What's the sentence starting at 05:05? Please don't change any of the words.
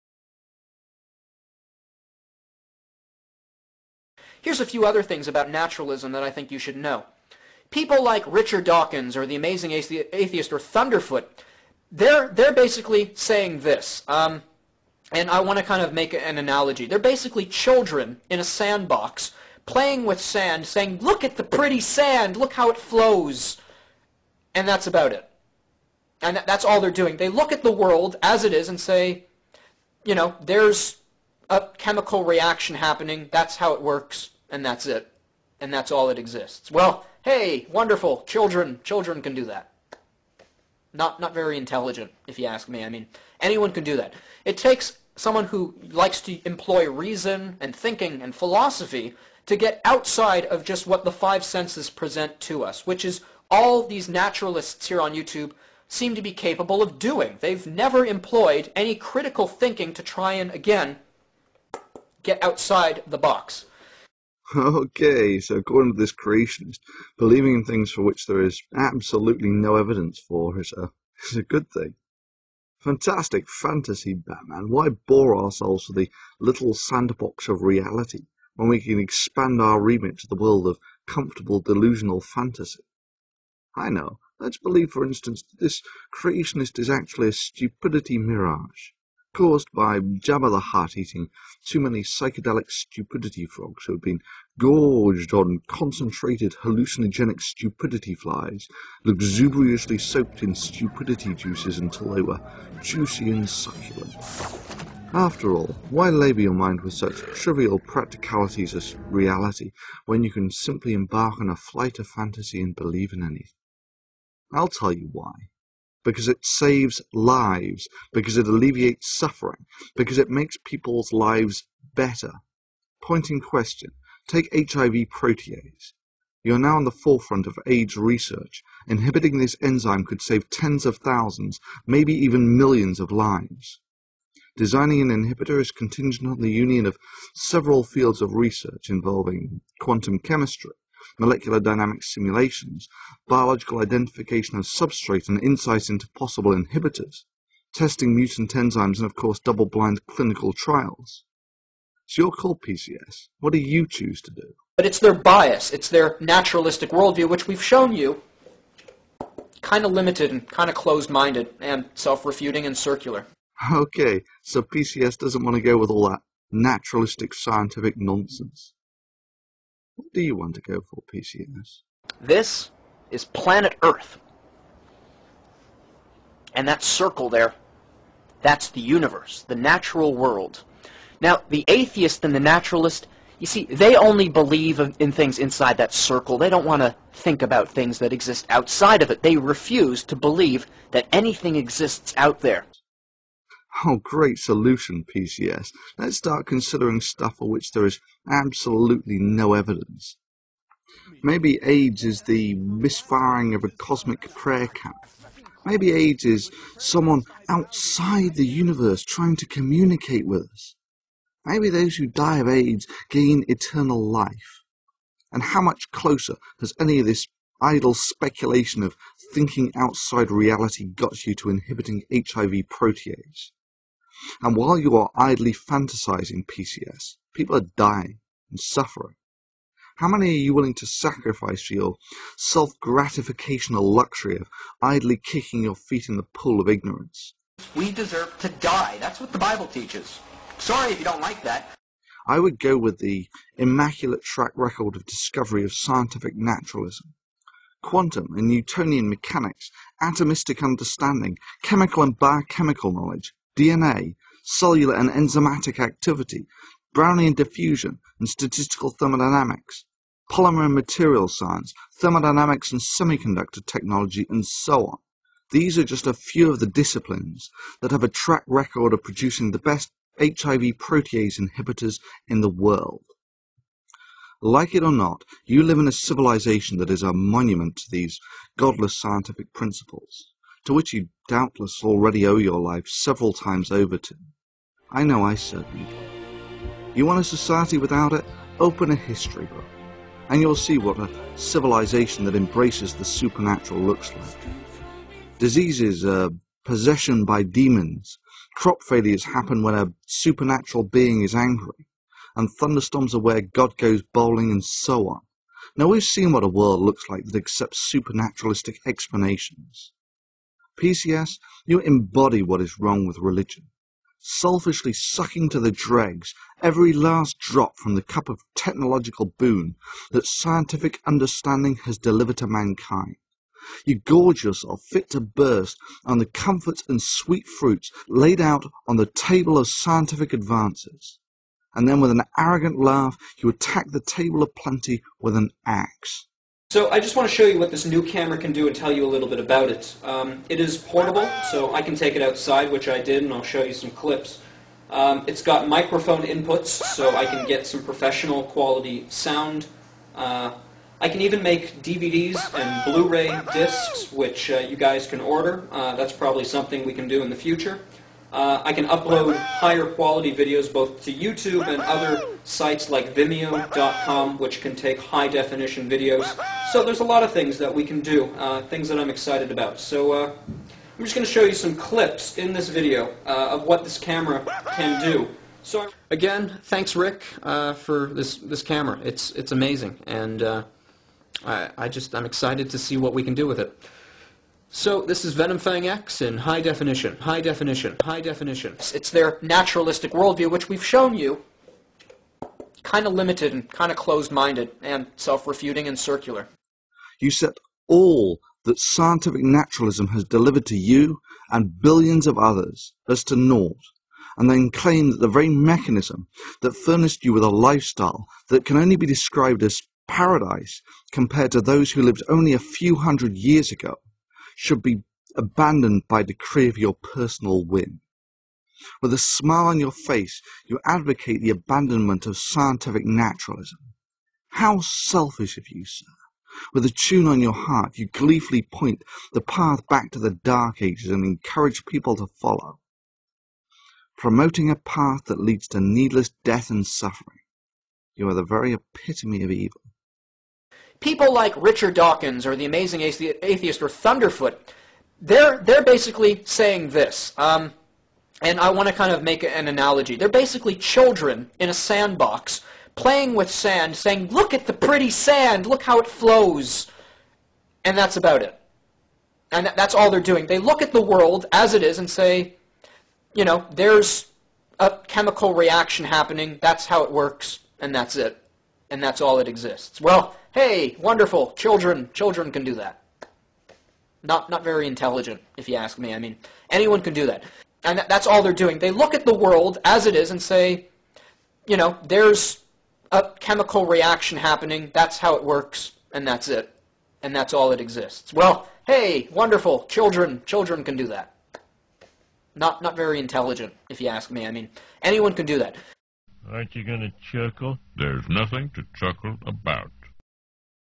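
Now we've seen what a world looks like that accepts supernaturalistic explanations.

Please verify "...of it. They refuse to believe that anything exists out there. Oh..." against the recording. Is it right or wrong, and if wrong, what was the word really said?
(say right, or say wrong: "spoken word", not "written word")
right.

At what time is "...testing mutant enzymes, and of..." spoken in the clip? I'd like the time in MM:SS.
02:27.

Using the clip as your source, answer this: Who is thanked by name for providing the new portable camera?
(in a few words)
Rick.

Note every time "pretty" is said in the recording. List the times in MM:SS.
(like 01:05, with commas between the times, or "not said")
00:21, 07:34.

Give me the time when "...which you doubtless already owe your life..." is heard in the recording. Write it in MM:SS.
04:40.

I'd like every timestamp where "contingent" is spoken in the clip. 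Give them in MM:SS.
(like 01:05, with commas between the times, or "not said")
02:15.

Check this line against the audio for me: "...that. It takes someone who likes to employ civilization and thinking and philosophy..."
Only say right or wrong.
wrong.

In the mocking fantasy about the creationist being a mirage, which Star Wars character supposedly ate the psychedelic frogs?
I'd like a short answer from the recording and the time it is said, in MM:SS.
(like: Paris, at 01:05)
Jabba the Hutt, at 01:29.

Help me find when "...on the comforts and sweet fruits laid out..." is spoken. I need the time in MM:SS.
05:26.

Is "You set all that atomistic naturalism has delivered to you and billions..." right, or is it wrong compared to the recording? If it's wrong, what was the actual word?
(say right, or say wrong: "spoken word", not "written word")
wrong: "scientific", not "atomistic".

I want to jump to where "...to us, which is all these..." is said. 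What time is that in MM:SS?
00:52.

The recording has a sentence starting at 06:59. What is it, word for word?
With a smile on your face, you advocate the abandonment of scientific naturalism.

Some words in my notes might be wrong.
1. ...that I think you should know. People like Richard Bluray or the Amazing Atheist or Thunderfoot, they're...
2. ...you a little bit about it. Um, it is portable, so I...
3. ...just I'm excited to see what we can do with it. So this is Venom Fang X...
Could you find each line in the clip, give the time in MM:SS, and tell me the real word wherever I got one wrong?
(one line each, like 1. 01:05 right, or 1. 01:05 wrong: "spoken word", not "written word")
1. 00:06 wrong: "Dawkins", not "Bluray"
2. 05:38 right
3. 06:21 right.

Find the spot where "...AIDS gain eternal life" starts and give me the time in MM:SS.
03:32.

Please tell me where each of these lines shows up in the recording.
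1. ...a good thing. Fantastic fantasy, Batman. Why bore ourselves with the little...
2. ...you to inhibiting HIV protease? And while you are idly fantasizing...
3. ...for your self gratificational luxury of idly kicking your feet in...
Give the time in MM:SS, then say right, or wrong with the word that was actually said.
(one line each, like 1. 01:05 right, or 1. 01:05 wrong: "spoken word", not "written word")
1. 01:11 right
2. 03:41 right
3. 03:51 right.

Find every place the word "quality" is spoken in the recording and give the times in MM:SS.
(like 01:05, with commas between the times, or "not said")
05:48, 05:59.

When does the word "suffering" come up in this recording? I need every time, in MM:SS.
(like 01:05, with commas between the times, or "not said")
01:59, 03:48, 07:16.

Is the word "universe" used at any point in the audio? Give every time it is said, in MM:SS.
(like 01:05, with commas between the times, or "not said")
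02:58, 03:28.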